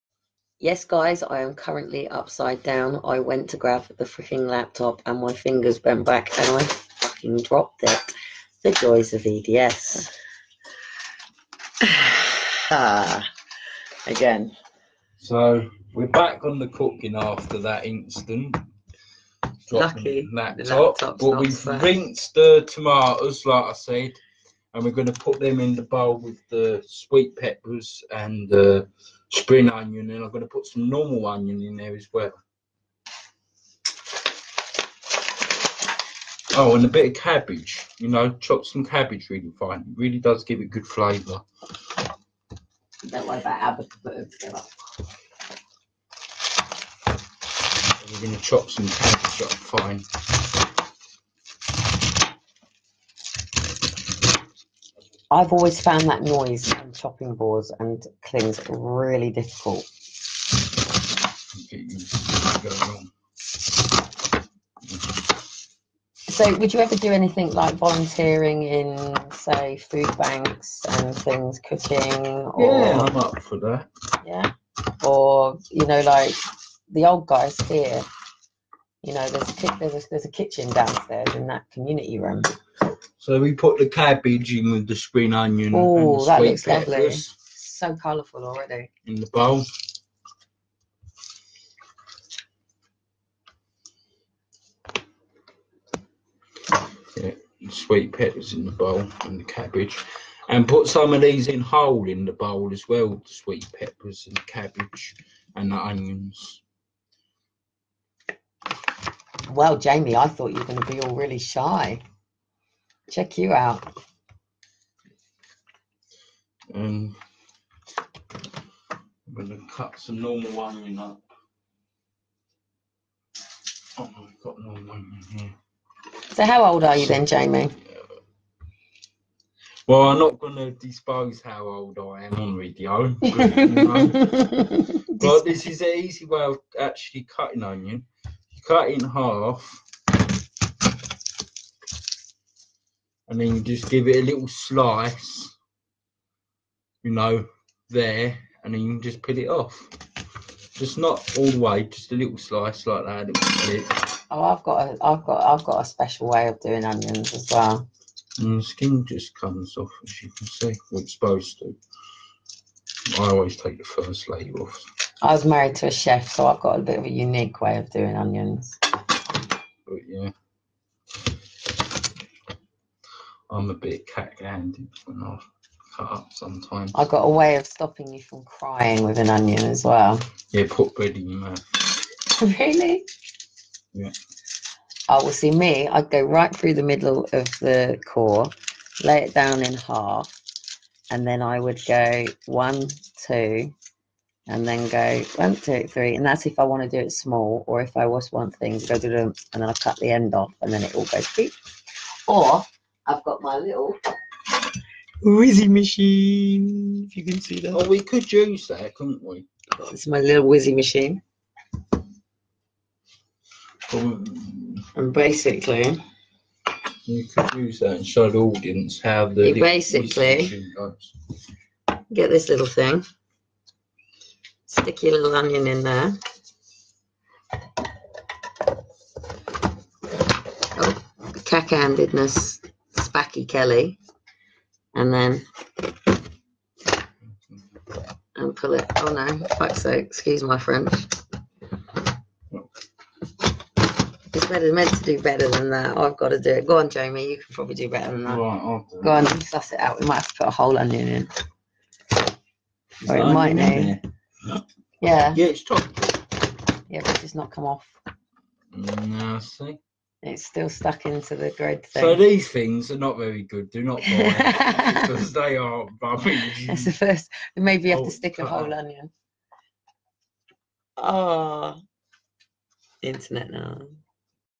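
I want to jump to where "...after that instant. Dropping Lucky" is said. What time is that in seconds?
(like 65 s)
17 s.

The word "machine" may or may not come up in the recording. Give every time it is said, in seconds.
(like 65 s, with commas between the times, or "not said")
205 s, 210 s.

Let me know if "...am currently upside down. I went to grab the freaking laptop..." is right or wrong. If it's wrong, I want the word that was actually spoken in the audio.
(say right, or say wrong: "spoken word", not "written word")
right.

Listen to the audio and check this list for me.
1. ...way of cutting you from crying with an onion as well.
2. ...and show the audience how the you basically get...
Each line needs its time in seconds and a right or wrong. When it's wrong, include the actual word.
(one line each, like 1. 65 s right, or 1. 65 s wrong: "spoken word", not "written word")
1. 177 s wrong: "stopping", not "cutting"
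2. 217 s right.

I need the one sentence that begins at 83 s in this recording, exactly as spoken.
So we put the cabbage in with the spring onion.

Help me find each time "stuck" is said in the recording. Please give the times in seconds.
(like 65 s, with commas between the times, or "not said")
260 s.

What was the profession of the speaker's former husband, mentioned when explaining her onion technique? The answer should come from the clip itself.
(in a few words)
Chef.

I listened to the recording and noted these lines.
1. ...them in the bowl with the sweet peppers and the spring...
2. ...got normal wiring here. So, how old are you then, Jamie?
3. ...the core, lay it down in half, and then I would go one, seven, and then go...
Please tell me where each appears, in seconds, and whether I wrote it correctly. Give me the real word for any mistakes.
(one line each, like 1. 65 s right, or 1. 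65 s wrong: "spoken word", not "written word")
1. 25 s right
2. 124 s right
3. 187 s wrong: "two", not "seven".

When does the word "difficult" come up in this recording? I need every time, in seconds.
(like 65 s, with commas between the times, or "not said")
59 s.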